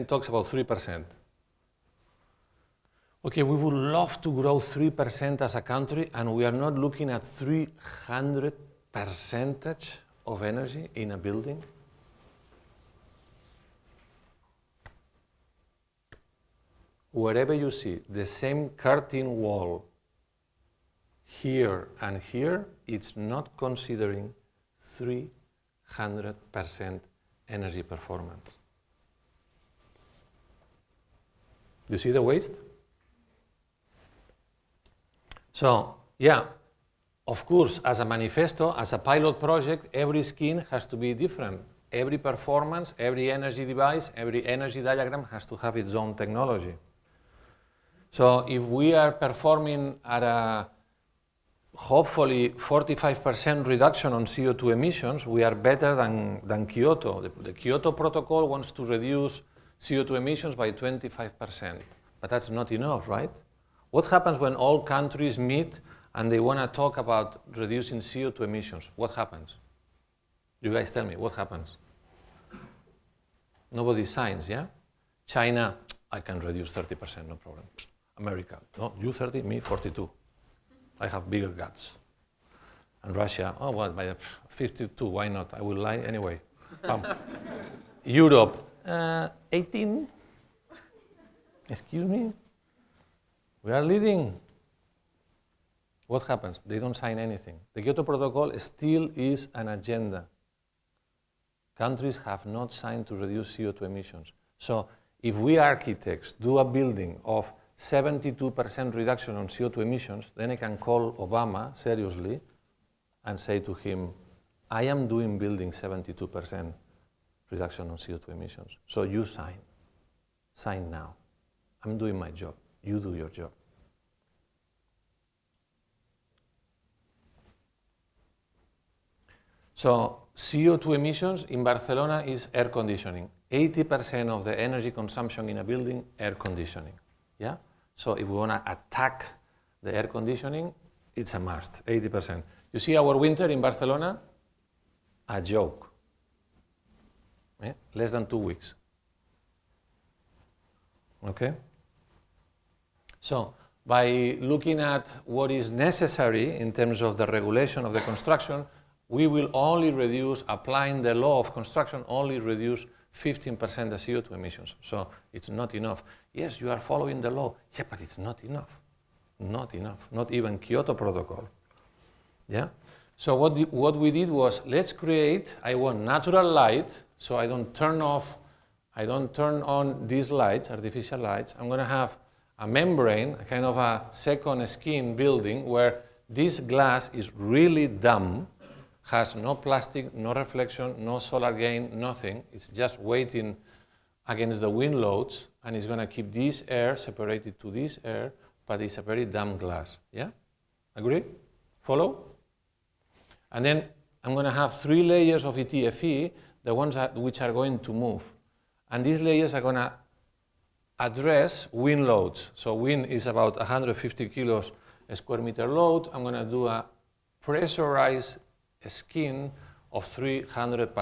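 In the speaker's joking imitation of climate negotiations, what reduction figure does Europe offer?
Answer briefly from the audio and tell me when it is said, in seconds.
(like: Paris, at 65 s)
18, at 89 s.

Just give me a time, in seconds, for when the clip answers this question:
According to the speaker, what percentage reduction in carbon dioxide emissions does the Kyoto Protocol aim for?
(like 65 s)
60 s.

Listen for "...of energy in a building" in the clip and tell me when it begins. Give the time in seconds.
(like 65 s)
10 s.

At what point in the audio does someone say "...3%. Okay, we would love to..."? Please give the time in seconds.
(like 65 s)
0 s.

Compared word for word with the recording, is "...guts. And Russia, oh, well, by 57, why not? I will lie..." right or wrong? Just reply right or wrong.
wrong.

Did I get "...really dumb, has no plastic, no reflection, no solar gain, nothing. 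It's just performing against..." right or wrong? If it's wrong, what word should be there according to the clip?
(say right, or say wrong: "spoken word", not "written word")
wrong: "waiting", not "performing".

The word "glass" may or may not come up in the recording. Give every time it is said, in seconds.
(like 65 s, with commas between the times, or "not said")
186 s, 199 s.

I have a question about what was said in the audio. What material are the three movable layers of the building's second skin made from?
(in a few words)
ETFE.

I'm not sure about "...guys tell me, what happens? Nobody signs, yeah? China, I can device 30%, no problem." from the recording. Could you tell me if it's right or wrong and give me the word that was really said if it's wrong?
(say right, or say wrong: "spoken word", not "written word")
wrong: "reduce", not "device".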